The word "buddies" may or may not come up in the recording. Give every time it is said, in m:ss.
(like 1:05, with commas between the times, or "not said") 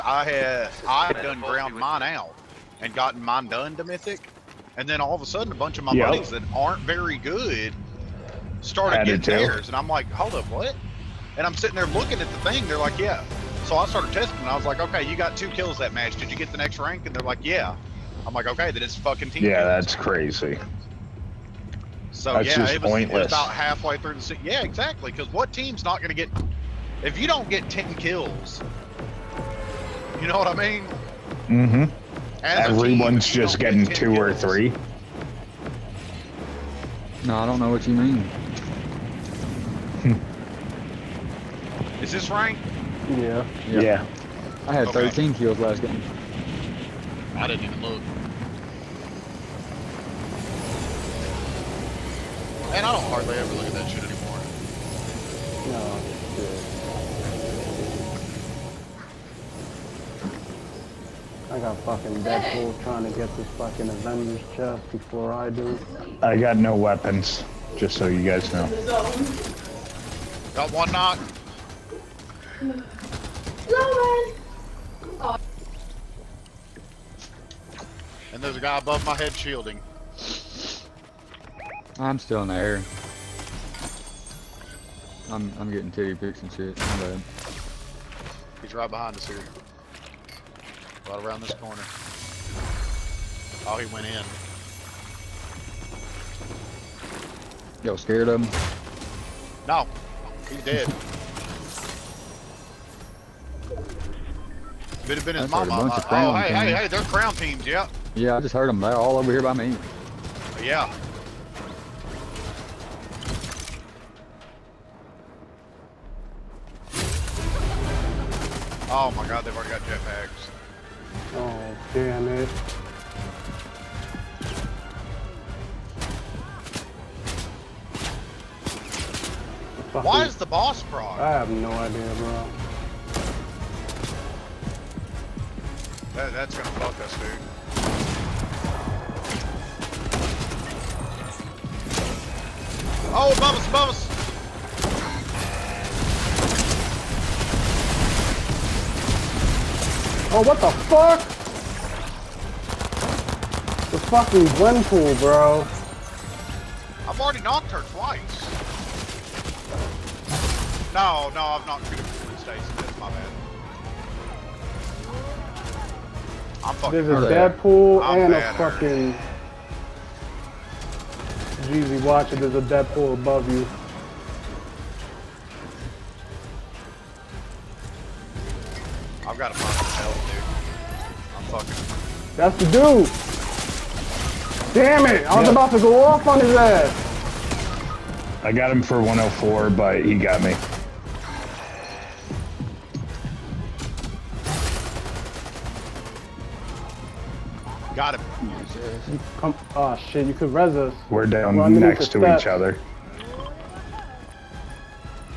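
0:06.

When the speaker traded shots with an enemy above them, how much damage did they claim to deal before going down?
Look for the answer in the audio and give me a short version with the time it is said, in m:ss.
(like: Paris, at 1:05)
104, at 3:09.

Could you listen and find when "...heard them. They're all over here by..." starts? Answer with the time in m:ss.
1:48.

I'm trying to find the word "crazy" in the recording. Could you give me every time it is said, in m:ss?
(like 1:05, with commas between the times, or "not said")
0:19.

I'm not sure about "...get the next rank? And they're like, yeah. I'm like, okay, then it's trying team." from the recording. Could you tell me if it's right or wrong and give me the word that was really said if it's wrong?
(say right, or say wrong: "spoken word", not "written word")
wrong: "fucking", not "trying".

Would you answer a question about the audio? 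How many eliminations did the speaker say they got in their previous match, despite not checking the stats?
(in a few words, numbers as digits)
13.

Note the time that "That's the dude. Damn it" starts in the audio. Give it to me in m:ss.
3:02.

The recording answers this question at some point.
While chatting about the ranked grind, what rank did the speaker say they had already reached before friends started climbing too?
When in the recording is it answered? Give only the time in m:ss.
0:03.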